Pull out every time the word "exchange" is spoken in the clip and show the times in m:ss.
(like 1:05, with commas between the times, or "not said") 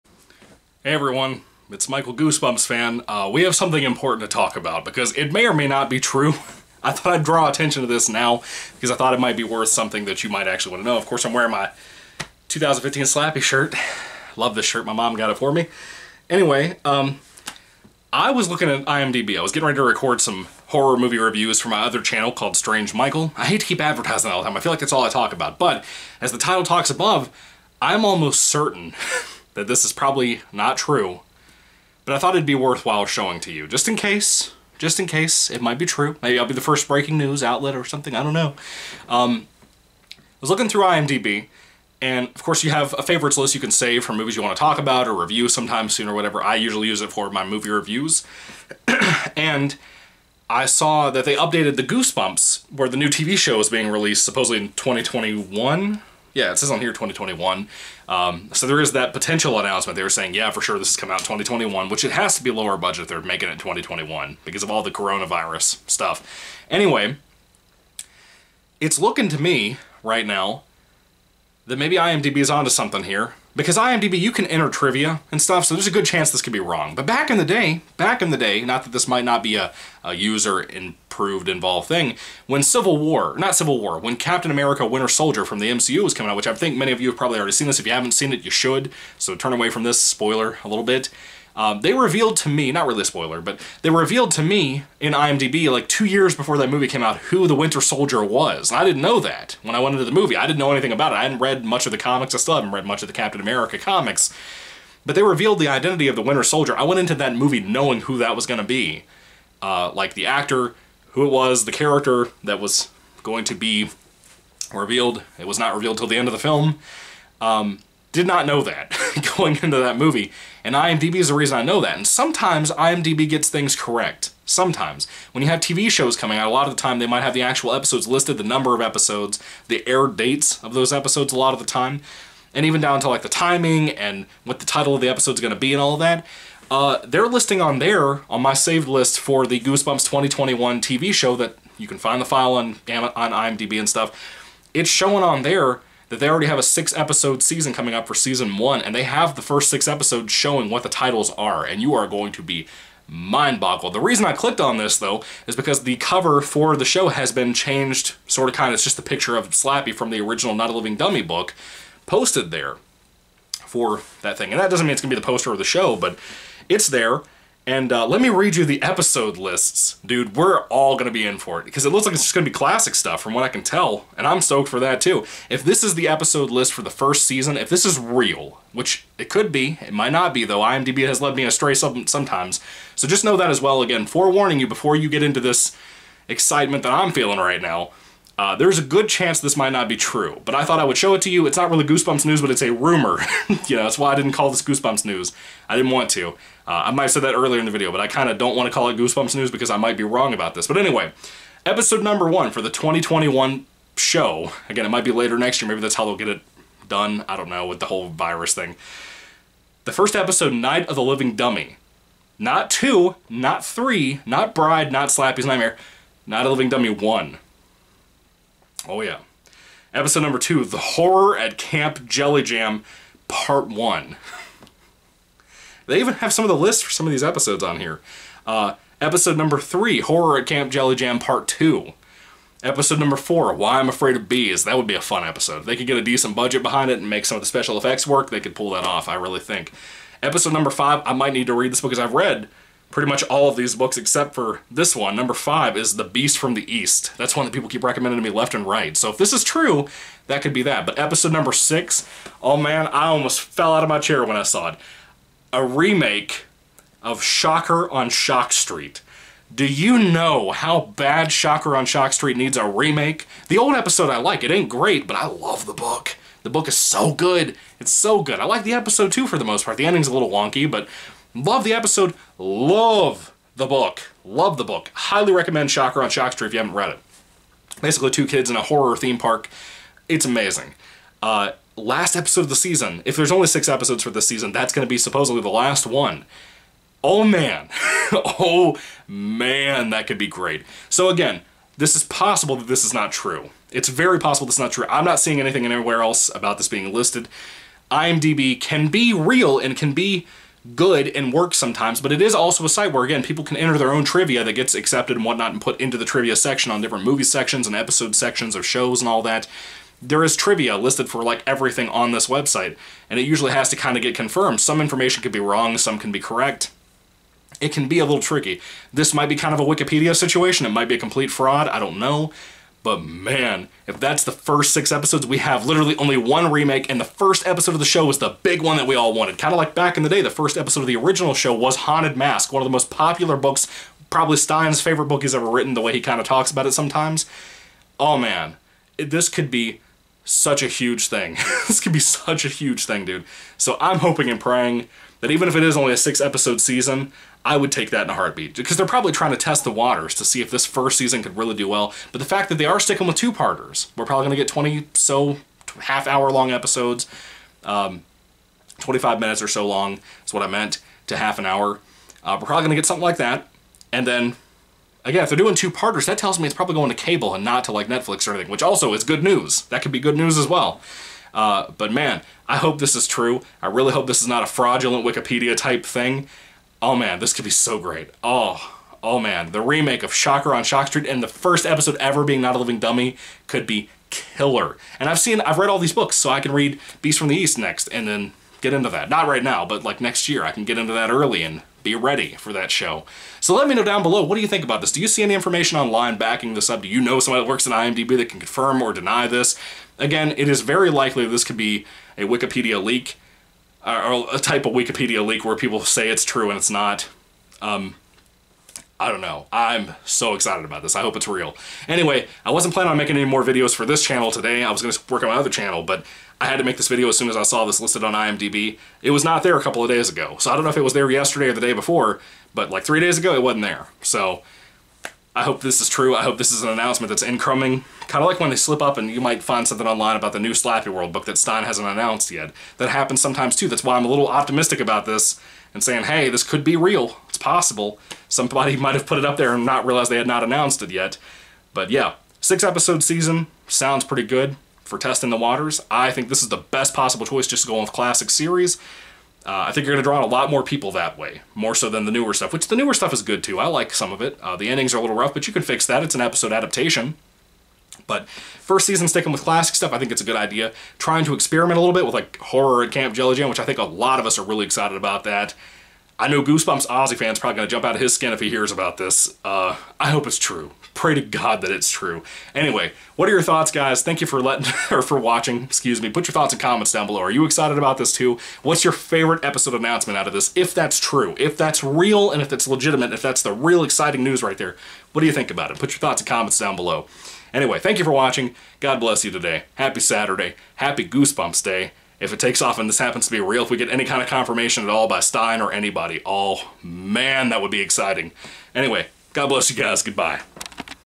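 not said.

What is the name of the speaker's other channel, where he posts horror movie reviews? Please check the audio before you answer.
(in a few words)
Strange Michael.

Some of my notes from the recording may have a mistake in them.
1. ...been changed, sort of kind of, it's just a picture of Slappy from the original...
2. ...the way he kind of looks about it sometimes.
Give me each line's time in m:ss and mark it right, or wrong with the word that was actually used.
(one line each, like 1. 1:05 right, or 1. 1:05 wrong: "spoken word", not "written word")
1. 2:37 right
2. 5:35 wrong: "talks", not "looks".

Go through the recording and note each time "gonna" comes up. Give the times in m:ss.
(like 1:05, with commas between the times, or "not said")
2:45, 7:47.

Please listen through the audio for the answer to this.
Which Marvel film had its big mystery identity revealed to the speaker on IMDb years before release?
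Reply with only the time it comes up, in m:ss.
1:24.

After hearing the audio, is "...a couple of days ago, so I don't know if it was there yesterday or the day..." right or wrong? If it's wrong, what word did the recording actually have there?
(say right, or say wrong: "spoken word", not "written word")
right.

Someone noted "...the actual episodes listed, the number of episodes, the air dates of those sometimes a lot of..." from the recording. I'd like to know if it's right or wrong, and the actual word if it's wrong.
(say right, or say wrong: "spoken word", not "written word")
wrong: "episodes", not "sometimes".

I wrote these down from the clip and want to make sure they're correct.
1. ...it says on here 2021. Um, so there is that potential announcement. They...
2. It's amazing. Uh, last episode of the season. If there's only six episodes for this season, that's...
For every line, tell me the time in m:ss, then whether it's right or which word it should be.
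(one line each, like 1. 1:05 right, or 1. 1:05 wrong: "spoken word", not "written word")
1. 0:56 right
2. 4:40 right.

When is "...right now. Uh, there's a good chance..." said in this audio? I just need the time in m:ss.
3:07.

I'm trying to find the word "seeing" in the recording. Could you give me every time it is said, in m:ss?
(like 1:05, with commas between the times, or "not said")
4:55.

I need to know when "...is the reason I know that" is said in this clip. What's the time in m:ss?
2:01.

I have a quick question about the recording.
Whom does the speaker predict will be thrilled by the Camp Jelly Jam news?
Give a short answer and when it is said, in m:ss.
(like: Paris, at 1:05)
Goosebumps Ozzy fan, at 7:46.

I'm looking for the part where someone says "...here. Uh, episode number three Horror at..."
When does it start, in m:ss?
3:47.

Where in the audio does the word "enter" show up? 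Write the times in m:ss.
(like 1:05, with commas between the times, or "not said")
1:14, 5:03.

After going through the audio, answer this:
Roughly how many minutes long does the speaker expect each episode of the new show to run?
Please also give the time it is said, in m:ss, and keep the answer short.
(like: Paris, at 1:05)
25, at 5:58.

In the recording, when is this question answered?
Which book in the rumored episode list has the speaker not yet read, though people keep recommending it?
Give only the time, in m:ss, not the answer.
4:05.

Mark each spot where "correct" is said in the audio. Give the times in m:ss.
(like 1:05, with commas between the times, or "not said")
2:03, 5:16.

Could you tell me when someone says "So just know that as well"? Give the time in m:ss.
3:02.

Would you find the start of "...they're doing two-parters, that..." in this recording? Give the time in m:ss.
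6:05.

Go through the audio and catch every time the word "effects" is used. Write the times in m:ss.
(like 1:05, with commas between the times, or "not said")
3:57.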